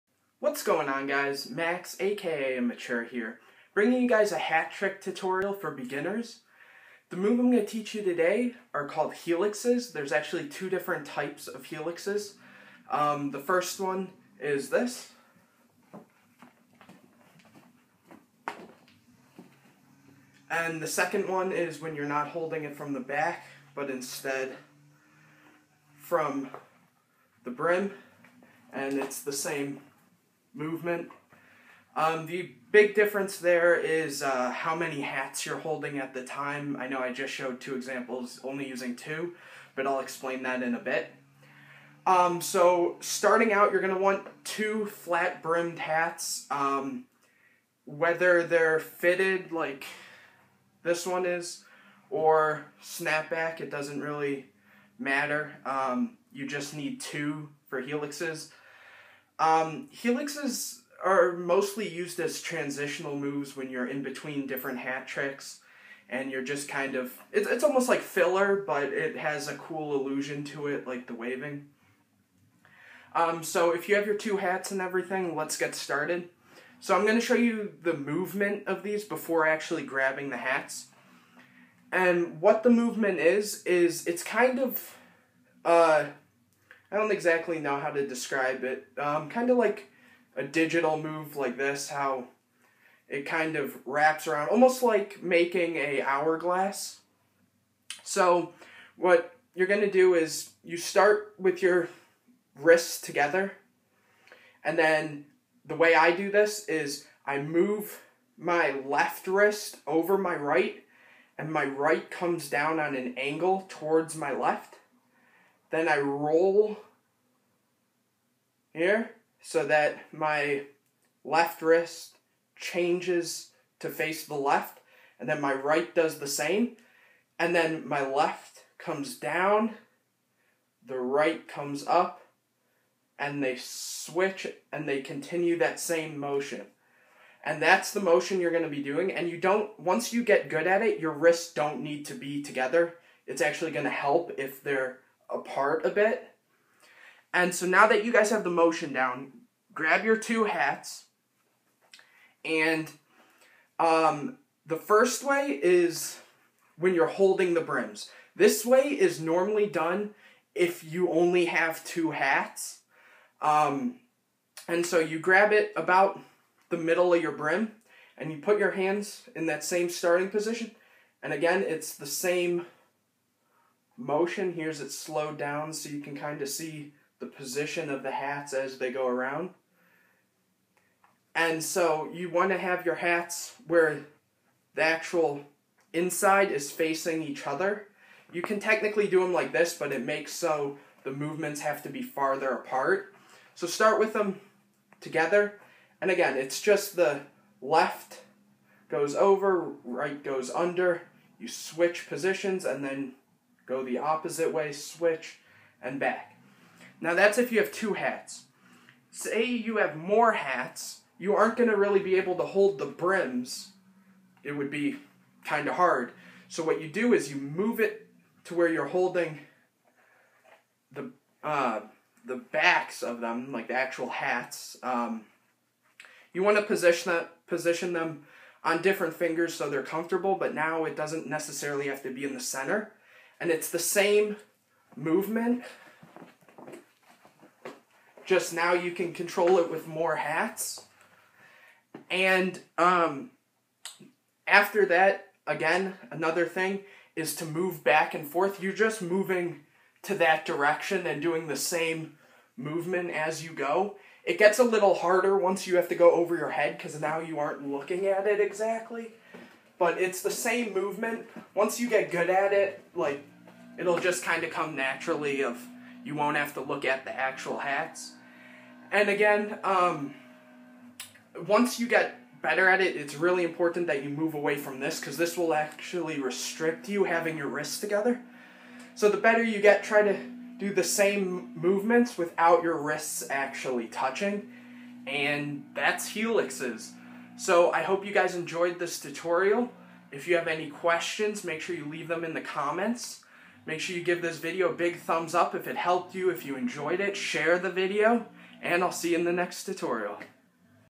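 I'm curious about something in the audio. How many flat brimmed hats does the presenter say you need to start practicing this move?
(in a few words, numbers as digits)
2.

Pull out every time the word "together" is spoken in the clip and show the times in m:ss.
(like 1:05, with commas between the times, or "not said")
1:42, 2:22, 3:14, 4:37.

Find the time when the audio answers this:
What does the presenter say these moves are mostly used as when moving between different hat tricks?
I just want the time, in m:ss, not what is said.
1:02.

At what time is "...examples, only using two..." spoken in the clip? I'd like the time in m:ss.
0:37.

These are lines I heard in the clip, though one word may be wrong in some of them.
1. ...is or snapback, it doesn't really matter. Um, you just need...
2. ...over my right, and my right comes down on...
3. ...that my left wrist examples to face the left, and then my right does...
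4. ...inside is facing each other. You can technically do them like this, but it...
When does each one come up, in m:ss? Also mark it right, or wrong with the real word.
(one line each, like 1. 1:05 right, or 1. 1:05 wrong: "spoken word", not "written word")
1. 0:51 right
2. 1:49 right
3. 1:59 wrong: "changes", not "examples"
4. 3:05 right.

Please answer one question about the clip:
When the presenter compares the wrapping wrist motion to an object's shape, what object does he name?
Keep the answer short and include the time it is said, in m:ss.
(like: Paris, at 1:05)
Hourglass, at 1:36.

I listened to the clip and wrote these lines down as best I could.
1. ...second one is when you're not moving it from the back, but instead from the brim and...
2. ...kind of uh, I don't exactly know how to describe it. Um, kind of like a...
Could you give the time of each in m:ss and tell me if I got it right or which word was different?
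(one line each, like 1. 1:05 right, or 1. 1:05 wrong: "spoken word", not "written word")
1. 0:20 wrong: "holding", not "moving"
2. 1:24 right.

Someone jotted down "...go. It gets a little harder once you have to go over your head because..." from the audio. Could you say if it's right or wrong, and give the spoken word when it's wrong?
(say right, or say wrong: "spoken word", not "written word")
right.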